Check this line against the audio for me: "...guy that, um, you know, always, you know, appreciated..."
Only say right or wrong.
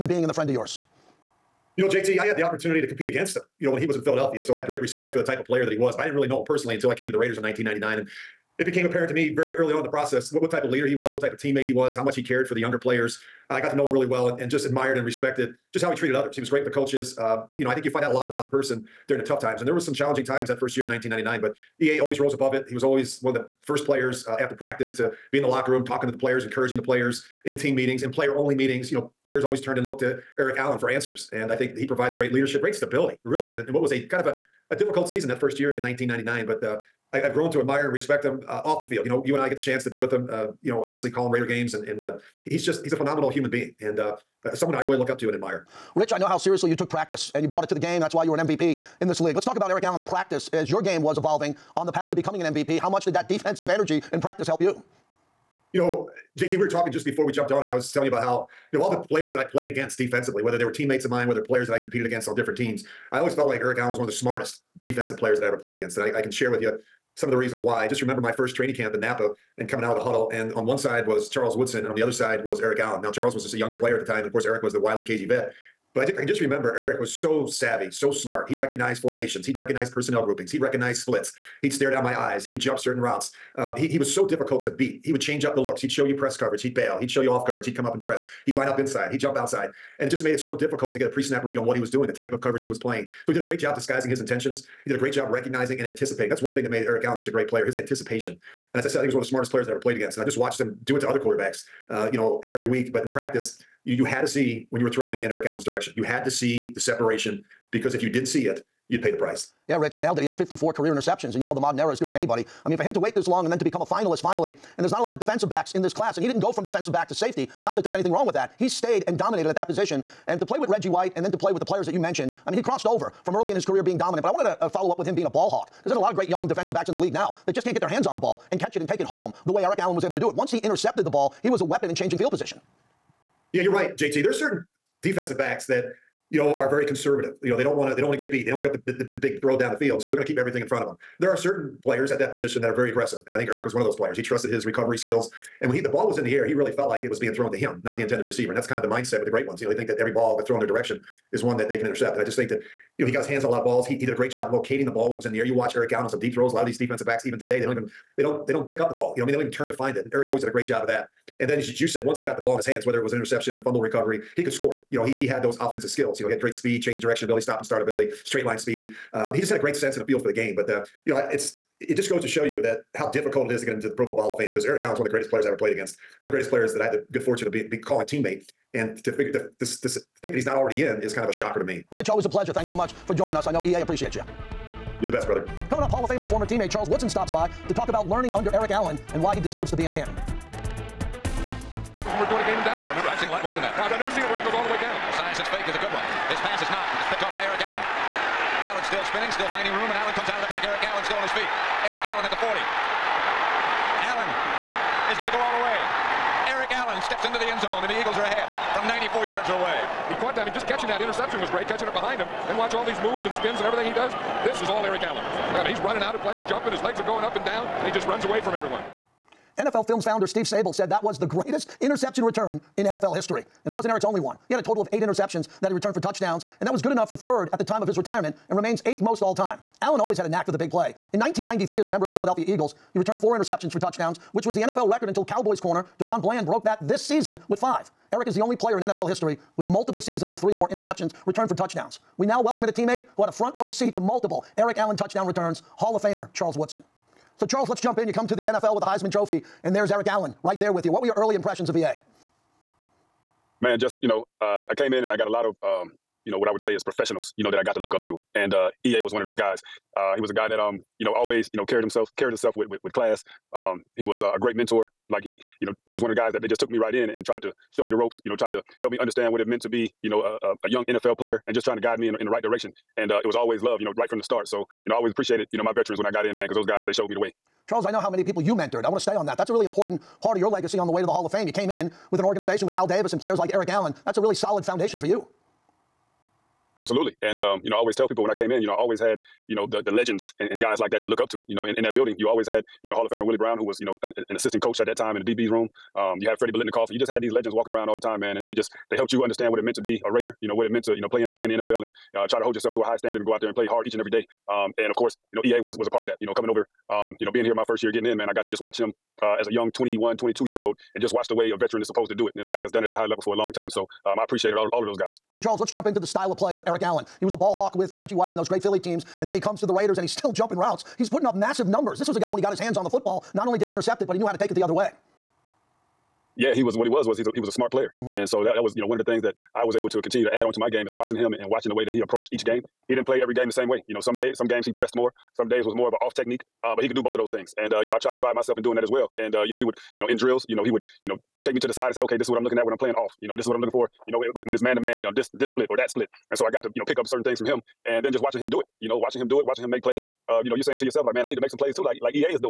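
wrong.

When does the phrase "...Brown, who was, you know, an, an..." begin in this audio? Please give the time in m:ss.
4:53.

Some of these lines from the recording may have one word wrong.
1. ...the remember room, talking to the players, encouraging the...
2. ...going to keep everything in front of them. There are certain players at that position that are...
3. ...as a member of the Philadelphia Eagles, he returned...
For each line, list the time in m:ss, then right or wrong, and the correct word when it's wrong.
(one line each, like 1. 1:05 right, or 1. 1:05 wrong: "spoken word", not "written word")
1. 0:25 wrong: "locker", not "remember"
2. 2:20 right
3. 3:51 right.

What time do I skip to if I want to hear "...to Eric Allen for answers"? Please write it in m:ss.
0:30.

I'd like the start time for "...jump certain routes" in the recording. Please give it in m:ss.
1:22.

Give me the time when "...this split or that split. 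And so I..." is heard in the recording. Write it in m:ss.
5:45.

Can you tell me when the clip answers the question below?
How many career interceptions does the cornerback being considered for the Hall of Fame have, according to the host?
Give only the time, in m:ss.
1:50.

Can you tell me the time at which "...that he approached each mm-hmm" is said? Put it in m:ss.
5:31.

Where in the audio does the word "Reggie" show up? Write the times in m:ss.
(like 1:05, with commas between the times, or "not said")
2:00, 5:17.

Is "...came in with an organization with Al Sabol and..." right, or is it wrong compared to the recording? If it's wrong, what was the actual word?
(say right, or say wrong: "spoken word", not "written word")
wrong: "Davis", not "Sabol".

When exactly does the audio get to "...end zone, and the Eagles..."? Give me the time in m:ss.
3:27.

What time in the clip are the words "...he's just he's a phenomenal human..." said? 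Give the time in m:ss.
0:42.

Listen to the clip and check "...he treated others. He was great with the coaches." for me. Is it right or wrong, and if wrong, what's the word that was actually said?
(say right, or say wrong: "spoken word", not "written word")
right.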